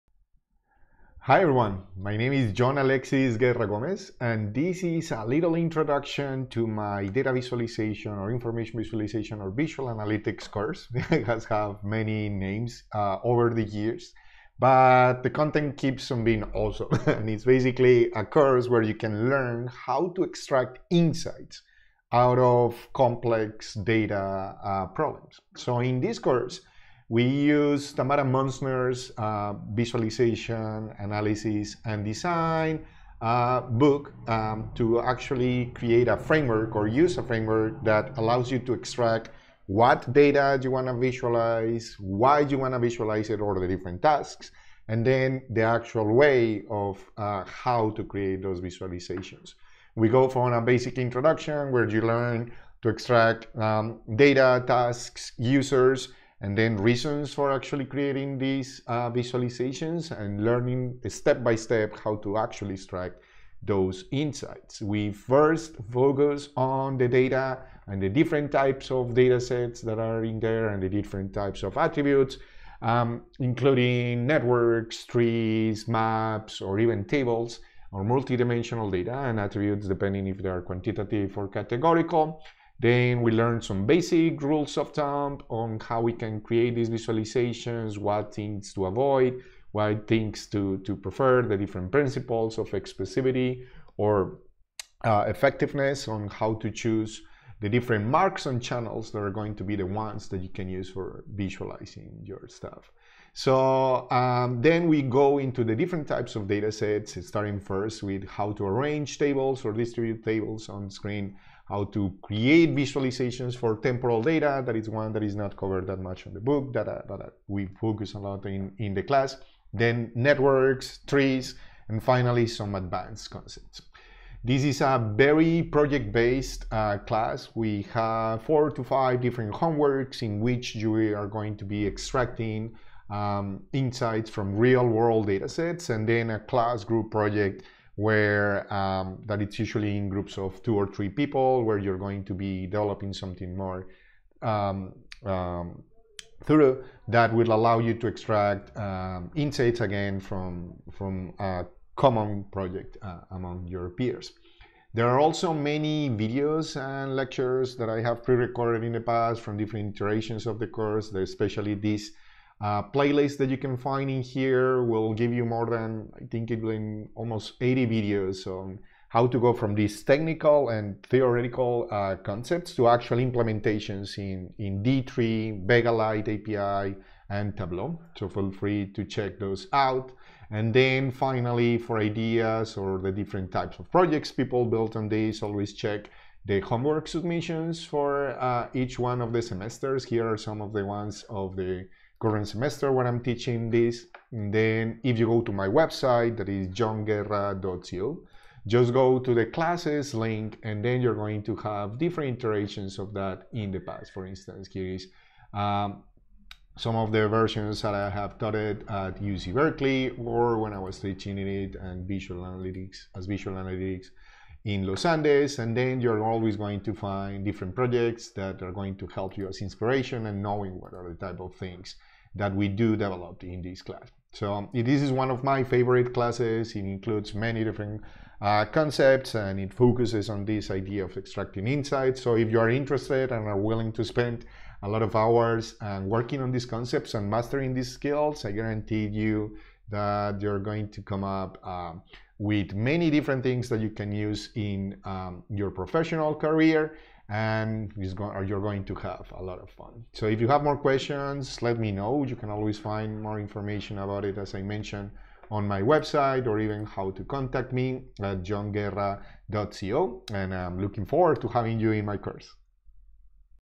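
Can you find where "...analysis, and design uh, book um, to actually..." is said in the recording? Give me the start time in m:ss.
0:30.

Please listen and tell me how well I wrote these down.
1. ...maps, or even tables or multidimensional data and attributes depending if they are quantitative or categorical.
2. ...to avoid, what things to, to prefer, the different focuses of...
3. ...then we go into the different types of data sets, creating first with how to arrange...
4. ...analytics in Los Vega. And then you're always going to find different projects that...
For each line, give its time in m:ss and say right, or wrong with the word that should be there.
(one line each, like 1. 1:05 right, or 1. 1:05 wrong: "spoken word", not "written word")
1. 1:15 right
2. 1:28 wrong: "principles", not "focuses"
3. 1:44 wrong: "starting", not "creating"
4. 3:33 wrong: "Andes", not "Vega".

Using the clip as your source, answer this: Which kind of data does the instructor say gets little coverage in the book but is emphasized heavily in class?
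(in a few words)
temporal data.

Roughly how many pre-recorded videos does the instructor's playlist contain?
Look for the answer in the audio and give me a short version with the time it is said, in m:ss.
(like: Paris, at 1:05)
80, at 2:47.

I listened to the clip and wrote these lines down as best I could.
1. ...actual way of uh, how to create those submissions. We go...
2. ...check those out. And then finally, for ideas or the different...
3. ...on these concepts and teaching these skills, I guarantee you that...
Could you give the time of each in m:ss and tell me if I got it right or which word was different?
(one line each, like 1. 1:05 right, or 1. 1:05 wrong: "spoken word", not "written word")
1. 0:45 wrong: "visualizations", not "submissions"
2. 2:59 right
3. 3:56 wrong: "mastering", not "teaching".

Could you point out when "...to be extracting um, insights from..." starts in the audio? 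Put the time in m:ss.
2:11.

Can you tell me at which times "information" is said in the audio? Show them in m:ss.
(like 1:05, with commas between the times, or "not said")
0:08, 4:13.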